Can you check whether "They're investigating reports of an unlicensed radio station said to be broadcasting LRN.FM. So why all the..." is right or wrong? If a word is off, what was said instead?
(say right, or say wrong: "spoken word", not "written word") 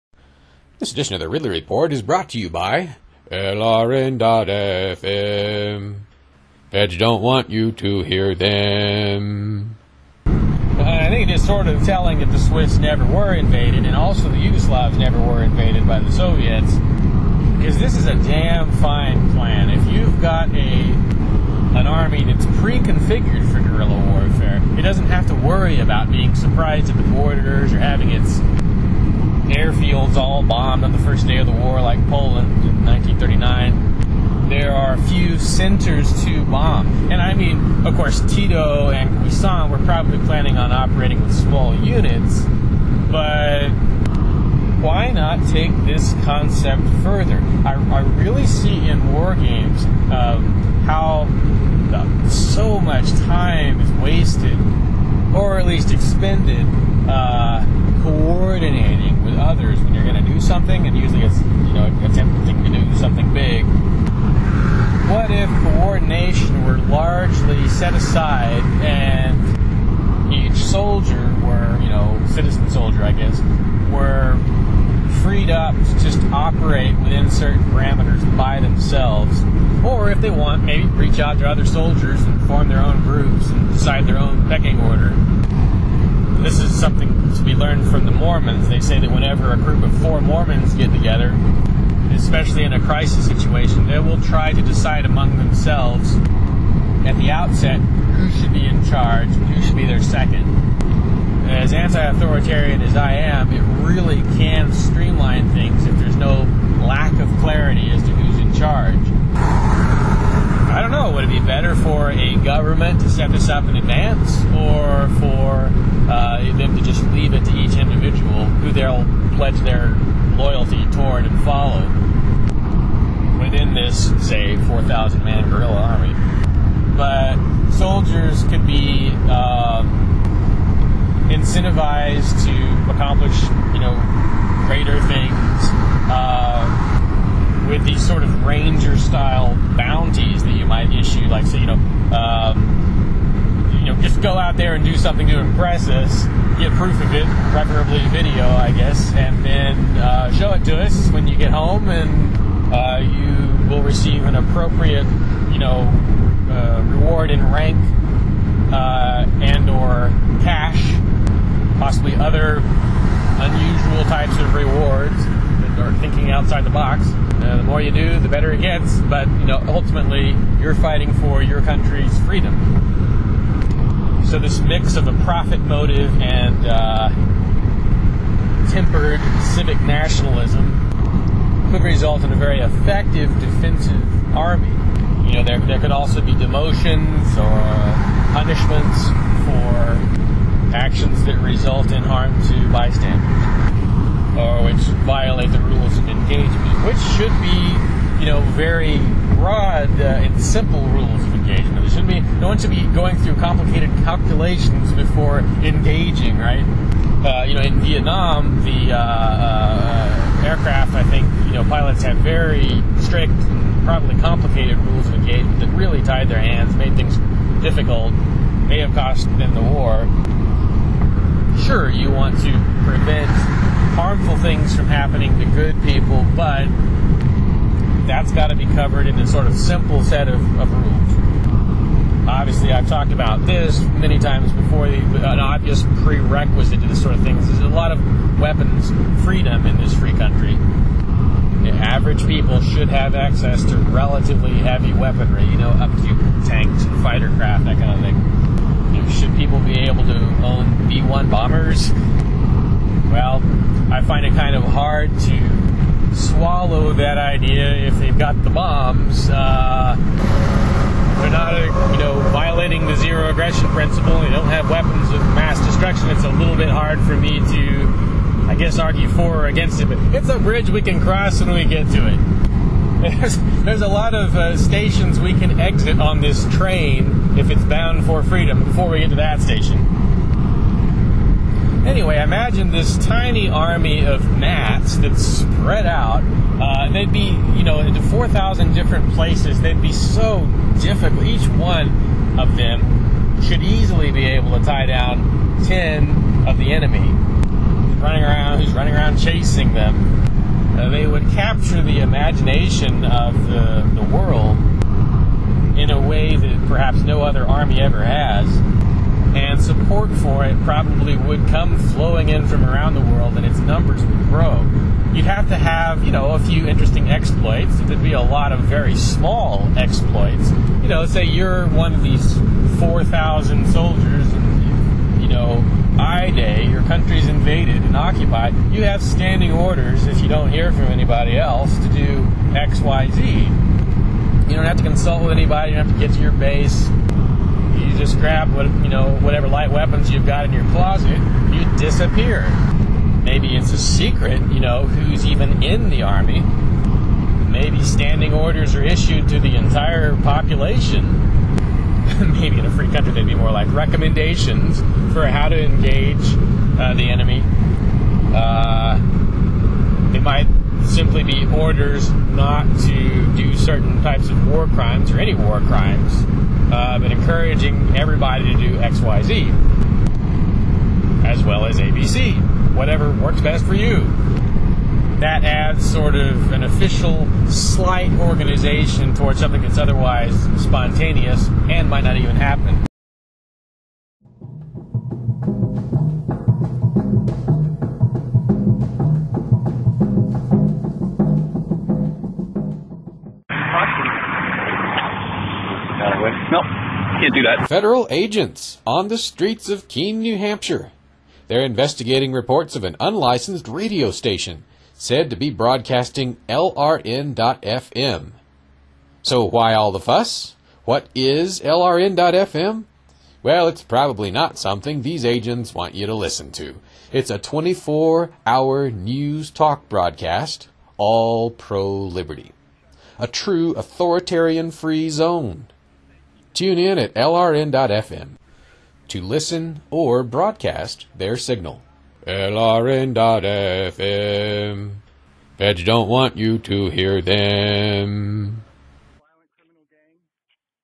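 right.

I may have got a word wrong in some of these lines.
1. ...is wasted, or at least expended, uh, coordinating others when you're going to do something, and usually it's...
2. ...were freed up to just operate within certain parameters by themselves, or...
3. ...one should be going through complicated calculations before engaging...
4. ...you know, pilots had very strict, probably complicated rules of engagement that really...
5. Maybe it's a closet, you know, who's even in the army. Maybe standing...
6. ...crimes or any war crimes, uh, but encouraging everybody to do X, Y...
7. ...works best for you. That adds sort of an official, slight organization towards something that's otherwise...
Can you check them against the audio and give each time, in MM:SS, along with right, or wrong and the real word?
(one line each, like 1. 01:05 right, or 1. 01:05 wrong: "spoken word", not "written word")
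1. 00:53 right
2. 01:13 right
3. 03:22 right
4. 03:31 right
5. 05:43 wrong: "secret", not "closet"
6. 06:04 right
7. 06:13 right.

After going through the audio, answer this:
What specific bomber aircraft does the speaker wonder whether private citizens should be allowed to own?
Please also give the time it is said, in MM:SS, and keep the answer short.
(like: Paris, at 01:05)
B-1, at 04:10.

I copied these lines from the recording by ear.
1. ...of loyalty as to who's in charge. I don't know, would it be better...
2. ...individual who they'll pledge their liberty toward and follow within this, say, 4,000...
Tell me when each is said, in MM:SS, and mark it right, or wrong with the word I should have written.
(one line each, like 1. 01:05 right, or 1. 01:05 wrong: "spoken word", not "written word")
1. 01:47 wrong: "clarity", not "loyalty"
2. 01:57 wrong: "loyalty", not "liberty".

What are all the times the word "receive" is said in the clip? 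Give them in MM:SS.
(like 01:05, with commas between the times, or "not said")
02:33.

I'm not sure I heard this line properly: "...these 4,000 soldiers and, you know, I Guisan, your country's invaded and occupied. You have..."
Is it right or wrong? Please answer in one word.
wrong.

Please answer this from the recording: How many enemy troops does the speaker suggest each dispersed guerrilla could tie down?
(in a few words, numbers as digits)
10.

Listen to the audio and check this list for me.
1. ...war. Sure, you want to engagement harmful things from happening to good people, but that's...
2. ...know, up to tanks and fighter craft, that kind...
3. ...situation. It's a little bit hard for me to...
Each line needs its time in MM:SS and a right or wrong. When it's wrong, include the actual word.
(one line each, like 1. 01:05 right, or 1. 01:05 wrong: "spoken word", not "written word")
1. 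03:39 wrong: "prevent", not "engagement"
2. 04:05 right
3. 04:25 wrong: "destruction", not "situation".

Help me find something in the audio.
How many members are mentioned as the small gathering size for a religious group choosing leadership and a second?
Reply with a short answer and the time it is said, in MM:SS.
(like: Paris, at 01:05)
4, at 01:30.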